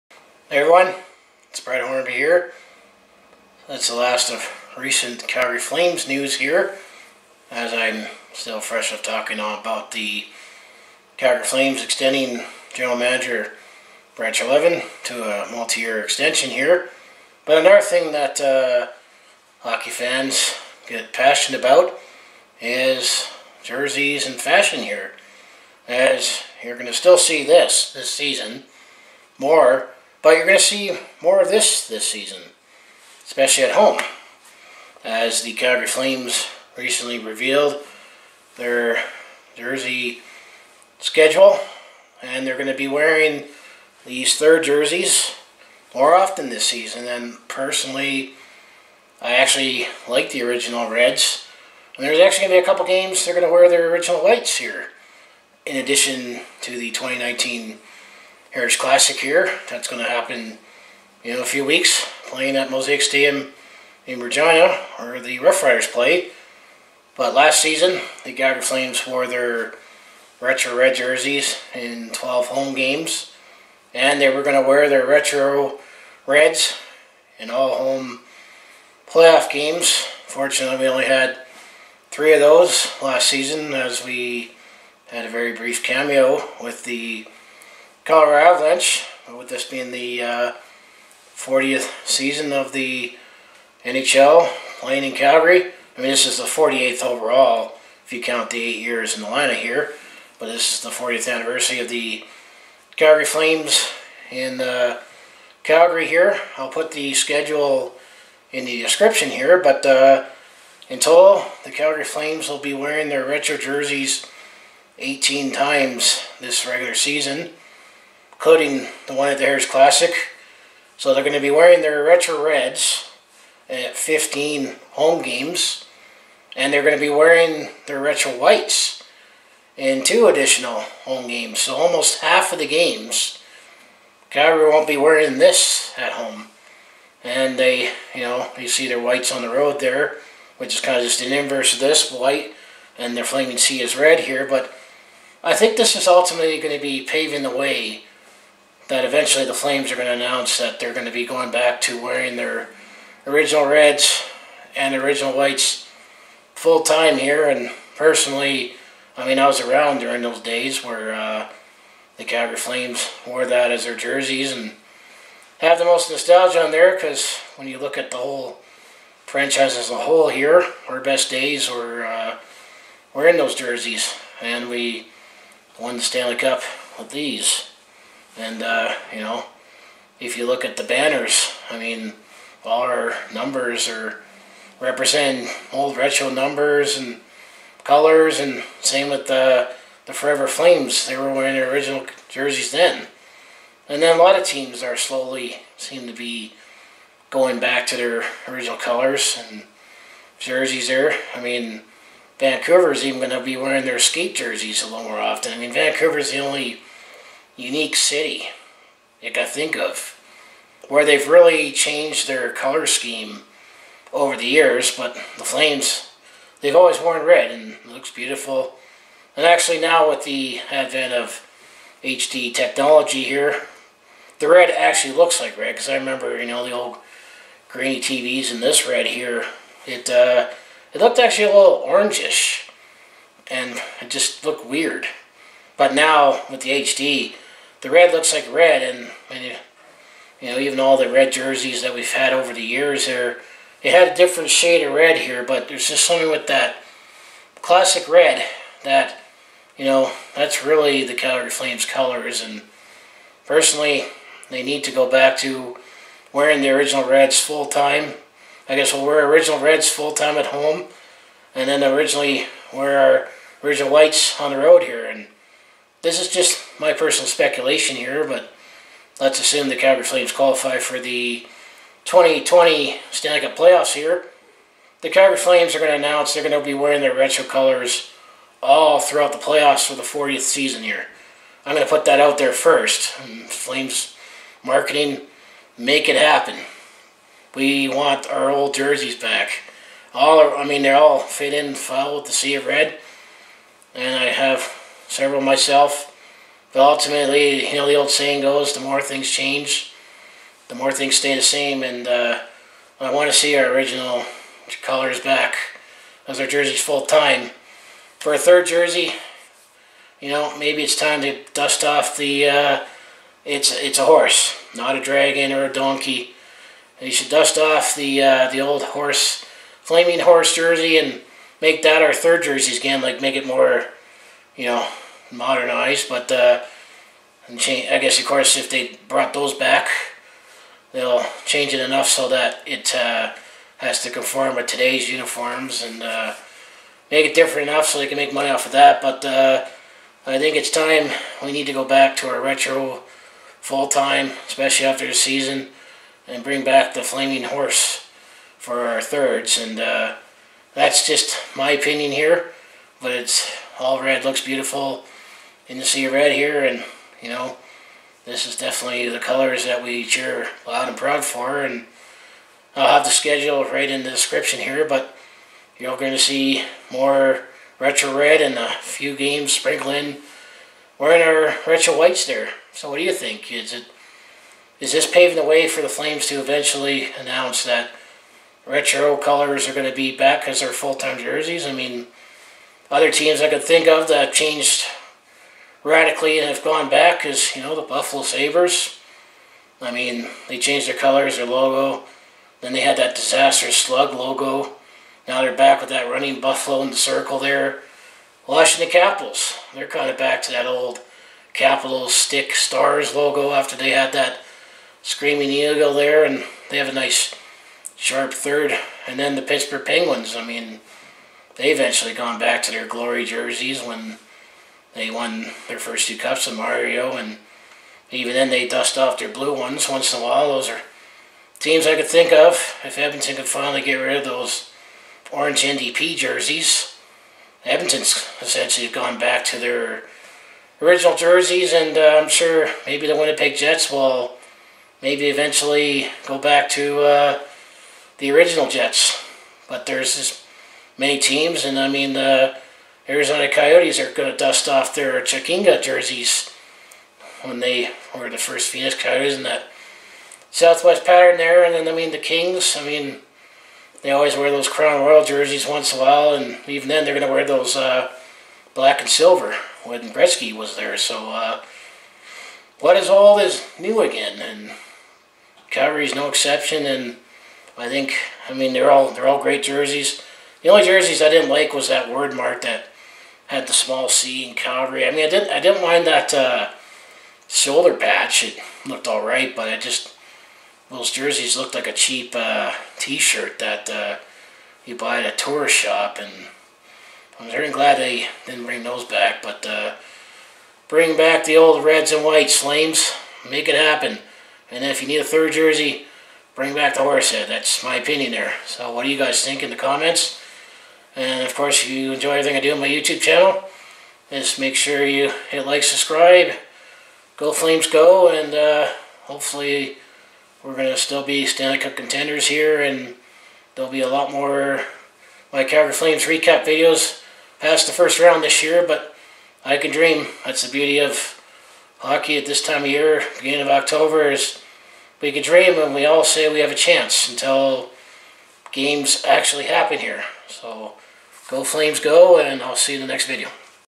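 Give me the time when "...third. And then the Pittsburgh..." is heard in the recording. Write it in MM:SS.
06:48.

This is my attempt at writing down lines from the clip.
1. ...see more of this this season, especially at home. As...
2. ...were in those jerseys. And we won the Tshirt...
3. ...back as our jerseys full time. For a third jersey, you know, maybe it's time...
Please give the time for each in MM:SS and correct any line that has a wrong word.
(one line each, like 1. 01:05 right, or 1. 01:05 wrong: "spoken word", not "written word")
1. 00:30 right
2. 02:53 wrong: "Stanley", not "Tshirt"
3. 05:05 right.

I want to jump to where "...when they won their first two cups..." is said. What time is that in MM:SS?
06:53.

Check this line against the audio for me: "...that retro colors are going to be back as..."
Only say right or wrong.
right.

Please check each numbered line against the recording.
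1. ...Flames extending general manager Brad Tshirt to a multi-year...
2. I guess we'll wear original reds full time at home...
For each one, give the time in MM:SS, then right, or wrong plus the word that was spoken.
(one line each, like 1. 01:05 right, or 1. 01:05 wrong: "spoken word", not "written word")
1. 00:11 wrong: "Treliving", not "Tshirt"
2. 04:18 right.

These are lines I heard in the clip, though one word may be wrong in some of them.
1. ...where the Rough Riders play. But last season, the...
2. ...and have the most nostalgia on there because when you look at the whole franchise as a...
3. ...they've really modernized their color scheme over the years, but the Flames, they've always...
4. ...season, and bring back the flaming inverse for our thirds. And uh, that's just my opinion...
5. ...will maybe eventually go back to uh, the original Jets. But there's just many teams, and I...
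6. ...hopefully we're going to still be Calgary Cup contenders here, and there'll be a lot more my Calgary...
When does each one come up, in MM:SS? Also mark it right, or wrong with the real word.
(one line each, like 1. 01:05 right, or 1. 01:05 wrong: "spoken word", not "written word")
1. 01:04 right
2. 02:44 right
3. 03:31 wrong: "changed", not "modernized"
4. 05:45 wrong: "horse", not "inverse"
5. 07:13 right
6. 08:29 wrong: "Stanley", not "Calgary".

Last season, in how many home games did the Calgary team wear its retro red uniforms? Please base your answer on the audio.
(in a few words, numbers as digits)
12.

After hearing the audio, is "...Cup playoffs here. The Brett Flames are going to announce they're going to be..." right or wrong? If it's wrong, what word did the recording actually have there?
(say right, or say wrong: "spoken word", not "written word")
wrong: "Calgary", not "Brett".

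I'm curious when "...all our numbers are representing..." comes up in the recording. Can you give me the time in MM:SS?
03:02.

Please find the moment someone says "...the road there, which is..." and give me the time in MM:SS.
02:19.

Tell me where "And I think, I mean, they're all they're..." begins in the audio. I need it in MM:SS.
07:46.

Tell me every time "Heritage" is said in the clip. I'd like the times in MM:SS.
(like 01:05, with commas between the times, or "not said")
00:58, 01:59.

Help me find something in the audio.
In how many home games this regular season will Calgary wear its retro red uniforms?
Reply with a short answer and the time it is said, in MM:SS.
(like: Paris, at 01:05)
15, at 02:03.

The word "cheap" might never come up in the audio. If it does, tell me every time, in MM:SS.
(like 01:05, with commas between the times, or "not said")
08:01.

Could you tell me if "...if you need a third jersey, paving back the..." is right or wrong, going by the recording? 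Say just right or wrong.
wrong.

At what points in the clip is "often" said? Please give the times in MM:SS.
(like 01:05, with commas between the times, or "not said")
00:46, 03:25.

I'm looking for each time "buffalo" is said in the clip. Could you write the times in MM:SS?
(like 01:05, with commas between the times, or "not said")
06:27, 06:36.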